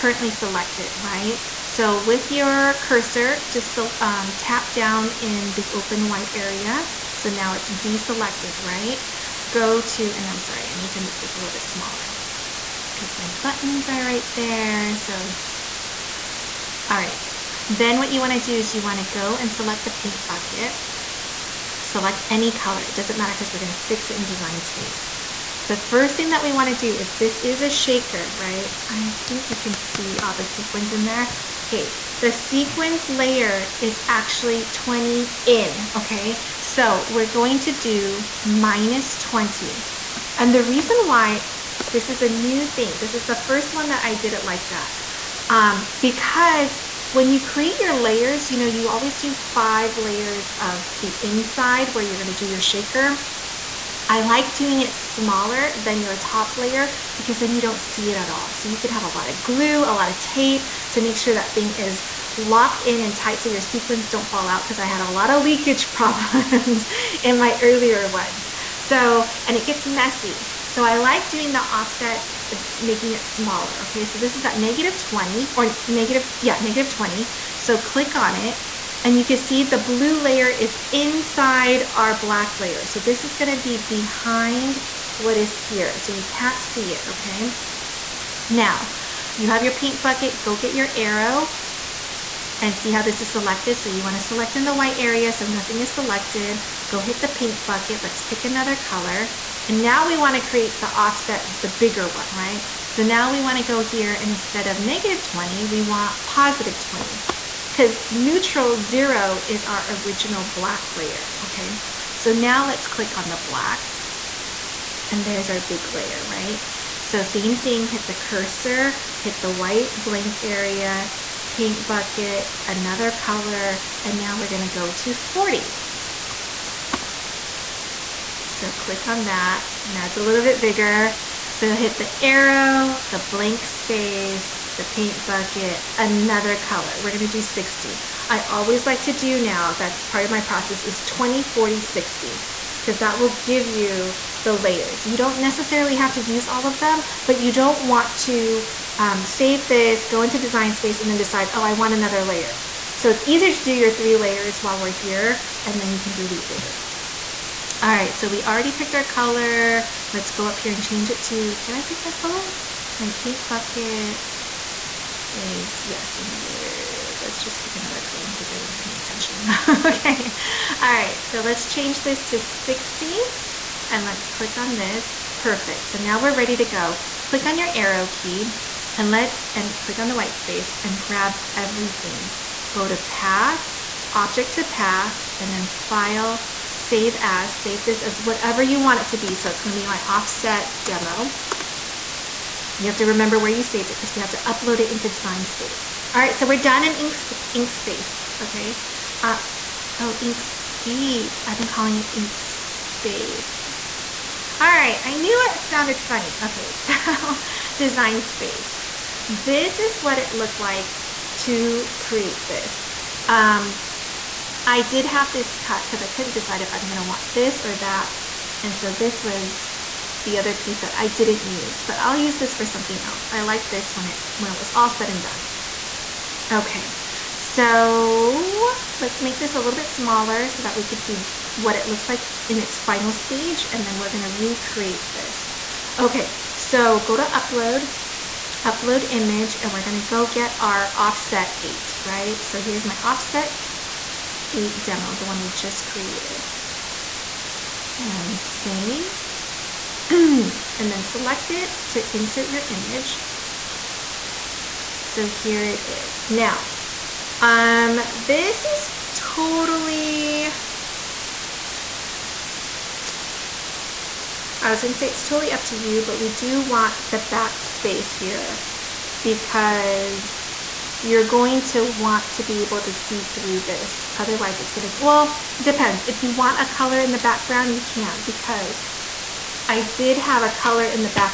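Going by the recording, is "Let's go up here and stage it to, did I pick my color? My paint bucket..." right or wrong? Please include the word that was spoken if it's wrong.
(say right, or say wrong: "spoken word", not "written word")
wrong: "change", not "stage".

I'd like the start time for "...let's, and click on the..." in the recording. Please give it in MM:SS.
02:59.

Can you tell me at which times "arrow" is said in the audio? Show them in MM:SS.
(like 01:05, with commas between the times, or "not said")
01:30, 02:12, 02:57.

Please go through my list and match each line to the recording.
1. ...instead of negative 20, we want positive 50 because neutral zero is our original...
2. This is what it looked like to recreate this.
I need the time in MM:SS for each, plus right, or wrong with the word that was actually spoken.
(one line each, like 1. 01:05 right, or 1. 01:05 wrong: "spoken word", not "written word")
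1. 01:44 wrong: "20", not "50"
2. 03:29 wrong: "create", not "recreate".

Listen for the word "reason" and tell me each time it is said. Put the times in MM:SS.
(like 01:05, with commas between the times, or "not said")
00:40.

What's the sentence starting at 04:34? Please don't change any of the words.
Otherwise, it's going to, well, depends.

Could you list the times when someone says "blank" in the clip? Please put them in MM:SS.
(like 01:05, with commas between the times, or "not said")
01:59, 02:13.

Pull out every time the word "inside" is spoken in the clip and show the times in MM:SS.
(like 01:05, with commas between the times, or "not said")
00:51, 01:20.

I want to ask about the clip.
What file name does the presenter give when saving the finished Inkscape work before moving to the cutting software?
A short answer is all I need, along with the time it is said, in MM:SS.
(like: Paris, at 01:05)
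my offset demo, at 03:09.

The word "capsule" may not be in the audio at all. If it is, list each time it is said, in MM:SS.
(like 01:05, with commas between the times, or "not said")
not said.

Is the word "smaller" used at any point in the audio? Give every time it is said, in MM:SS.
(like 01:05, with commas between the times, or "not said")
00:11, 00:55, 01:13, 03:49.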